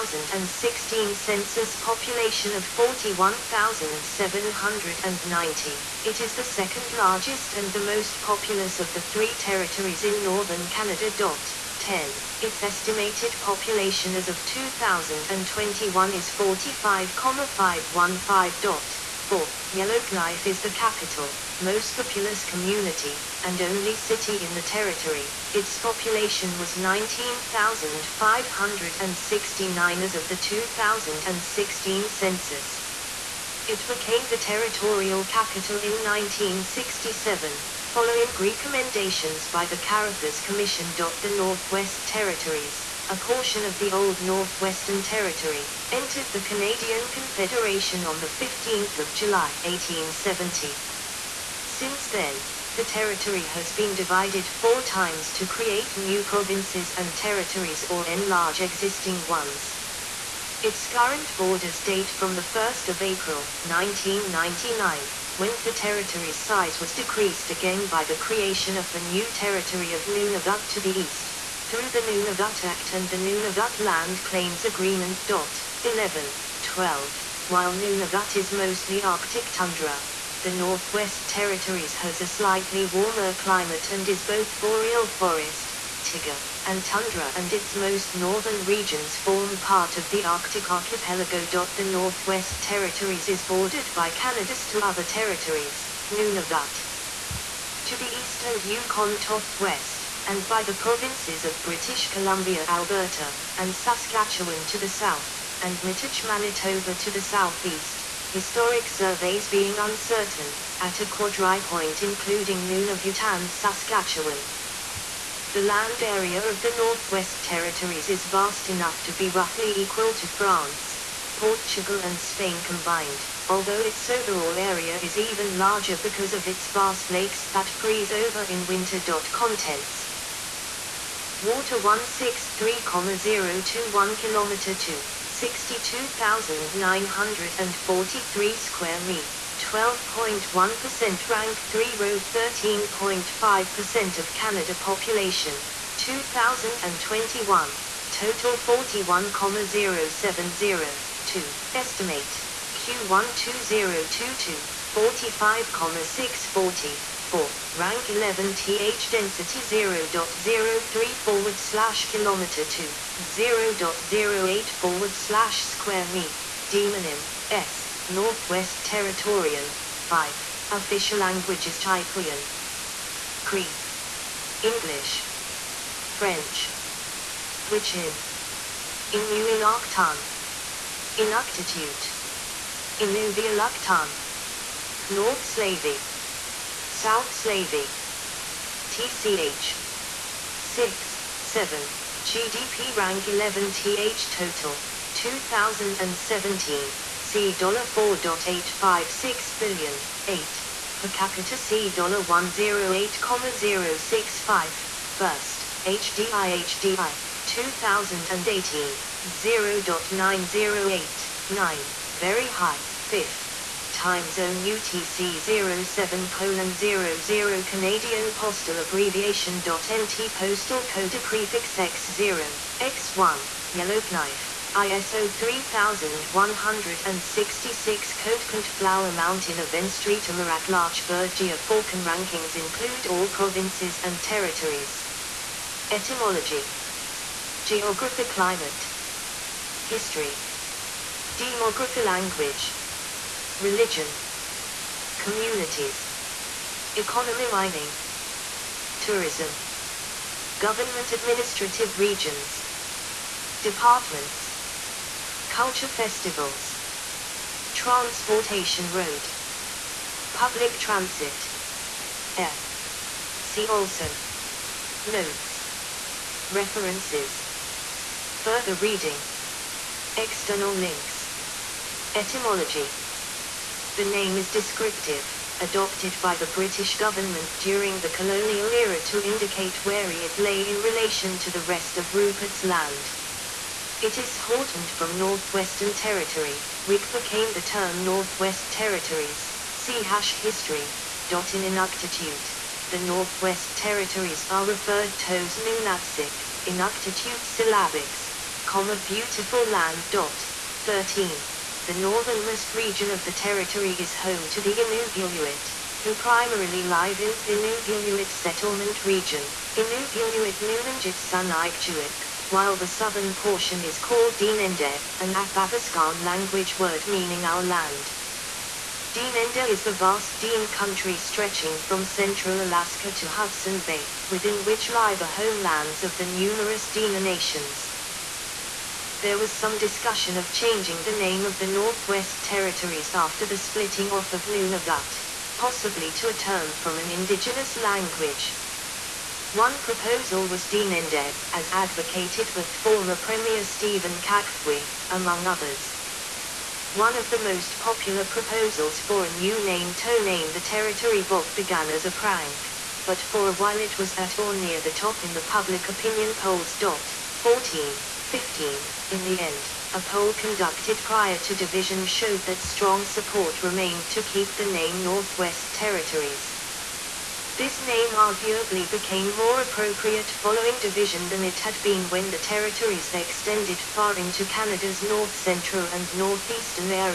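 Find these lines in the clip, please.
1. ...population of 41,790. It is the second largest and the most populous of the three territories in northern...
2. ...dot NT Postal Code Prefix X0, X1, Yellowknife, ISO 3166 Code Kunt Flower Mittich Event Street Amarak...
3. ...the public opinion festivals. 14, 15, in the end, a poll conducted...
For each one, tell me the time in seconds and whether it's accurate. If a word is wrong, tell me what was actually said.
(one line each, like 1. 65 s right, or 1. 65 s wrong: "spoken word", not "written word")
1. 1 s right
2. 219 s wrong: "Mountain", not "Mittich"
3. 355 s wrong: "polls", not "festivals".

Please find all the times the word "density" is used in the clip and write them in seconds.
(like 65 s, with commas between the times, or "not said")
159 s.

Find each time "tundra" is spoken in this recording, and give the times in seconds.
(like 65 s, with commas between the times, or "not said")
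79 s, 86 s.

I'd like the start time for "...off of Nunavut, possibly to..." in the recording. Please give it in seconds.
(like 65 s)
334 s.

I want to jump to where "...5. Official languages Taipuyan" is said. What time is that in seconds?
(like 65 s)
170 s.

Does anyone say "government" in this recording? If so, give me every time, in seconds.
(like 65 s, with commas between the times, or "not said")
250 s, 276 s.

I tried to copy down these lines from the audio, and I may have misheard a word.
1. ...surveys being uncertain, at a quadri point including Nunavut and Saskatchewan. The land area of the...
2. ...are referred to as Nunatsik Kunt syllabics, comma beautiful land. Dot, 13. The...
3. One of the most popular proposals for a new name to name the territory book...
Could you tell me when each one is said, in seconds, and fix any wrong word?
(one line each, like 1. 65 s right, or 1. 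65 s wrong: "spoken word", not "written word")
1. 108 s right
2. 294 s wrong: "Inuktitut", not "Kunt"
3. 346 s right.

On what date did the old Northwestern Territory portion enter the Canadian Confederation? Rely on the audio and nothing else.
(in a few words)
15 July 1870.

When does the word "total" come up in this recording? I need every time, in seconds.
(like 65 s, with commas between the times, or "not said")
148 s, 194 s.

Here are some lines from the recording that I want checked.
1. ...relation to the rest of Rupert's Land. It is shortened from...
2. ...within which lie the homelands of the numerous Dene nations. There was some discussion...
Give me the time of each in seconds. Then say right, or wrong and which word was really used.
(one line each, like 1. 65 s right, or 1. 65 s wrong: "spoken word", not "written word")
1. 280 s right
2. 324 s right.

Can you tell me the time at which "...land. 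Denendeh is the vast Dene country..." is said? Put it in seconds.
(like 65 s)
317 s.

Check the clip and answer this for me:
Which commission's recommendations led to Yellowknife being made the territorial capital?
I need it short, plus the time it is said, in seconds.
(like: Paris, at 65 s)
Carruthers Commission, at 39 s.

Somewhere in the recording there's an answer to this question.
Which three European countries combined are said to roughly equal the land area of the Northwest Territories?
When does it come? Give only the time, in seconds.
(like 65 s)
120 s.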